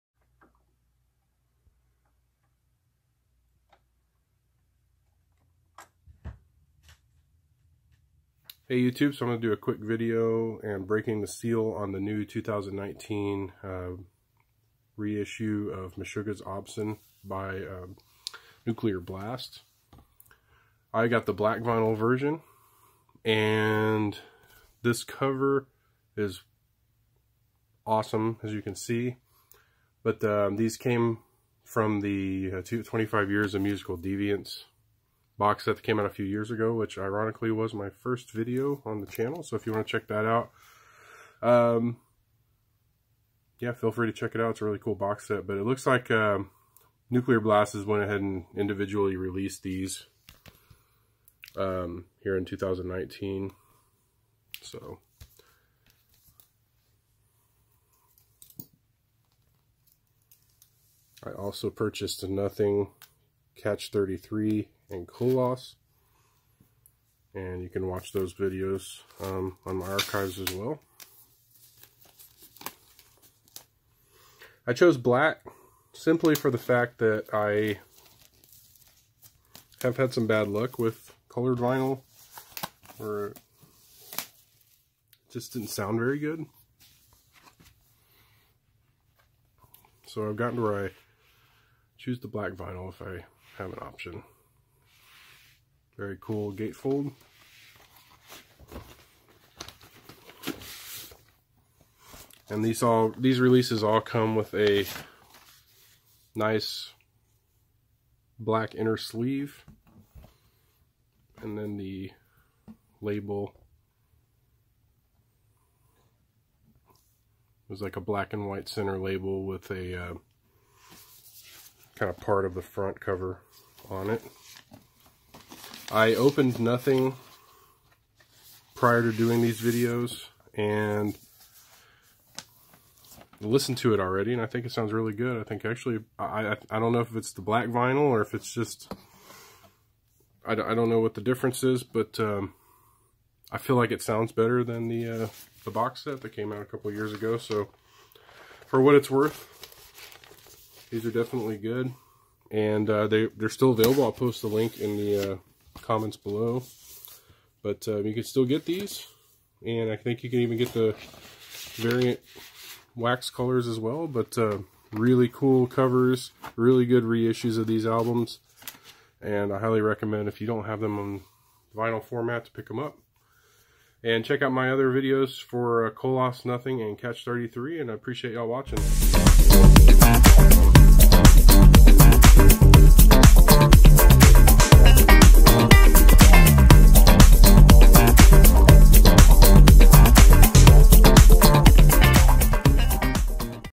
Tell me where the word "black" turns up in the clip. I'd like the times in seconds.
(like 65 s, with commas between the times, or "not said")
21 s, 74 s, 92 s, 108 s, 118 s, 137 s.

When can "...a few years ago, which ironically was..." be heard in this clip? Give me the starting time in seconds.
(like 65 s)
36 s.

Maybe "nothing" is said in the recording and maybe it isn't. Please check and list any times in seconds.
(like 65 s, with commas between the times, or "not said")
62 s, 126 s, 176 s.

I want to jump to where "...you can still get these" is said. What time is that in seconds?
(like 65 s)
158 s.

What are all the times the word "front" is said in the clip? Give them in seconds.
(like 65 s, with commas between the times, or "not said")
122 s.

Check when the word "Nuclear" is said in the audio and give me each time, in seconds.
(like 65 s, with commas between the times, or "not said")
18 s, 47 s.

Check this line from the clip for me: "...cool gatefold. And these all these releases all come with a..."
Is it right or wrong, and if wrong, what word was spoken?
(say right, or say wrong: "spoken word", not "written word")
right.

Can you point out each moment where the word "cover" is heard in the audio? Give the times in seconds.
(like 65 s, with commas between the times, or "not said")
25 s, 122 s, 165 s.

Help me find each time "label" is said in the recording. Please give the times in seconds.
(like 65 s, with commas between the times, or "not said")
113 s, 118 s.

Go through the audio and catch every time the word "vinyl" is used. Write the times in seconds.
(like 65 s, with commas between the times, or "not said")
21 s, 81 s, 92 s, 137 s, 171 s.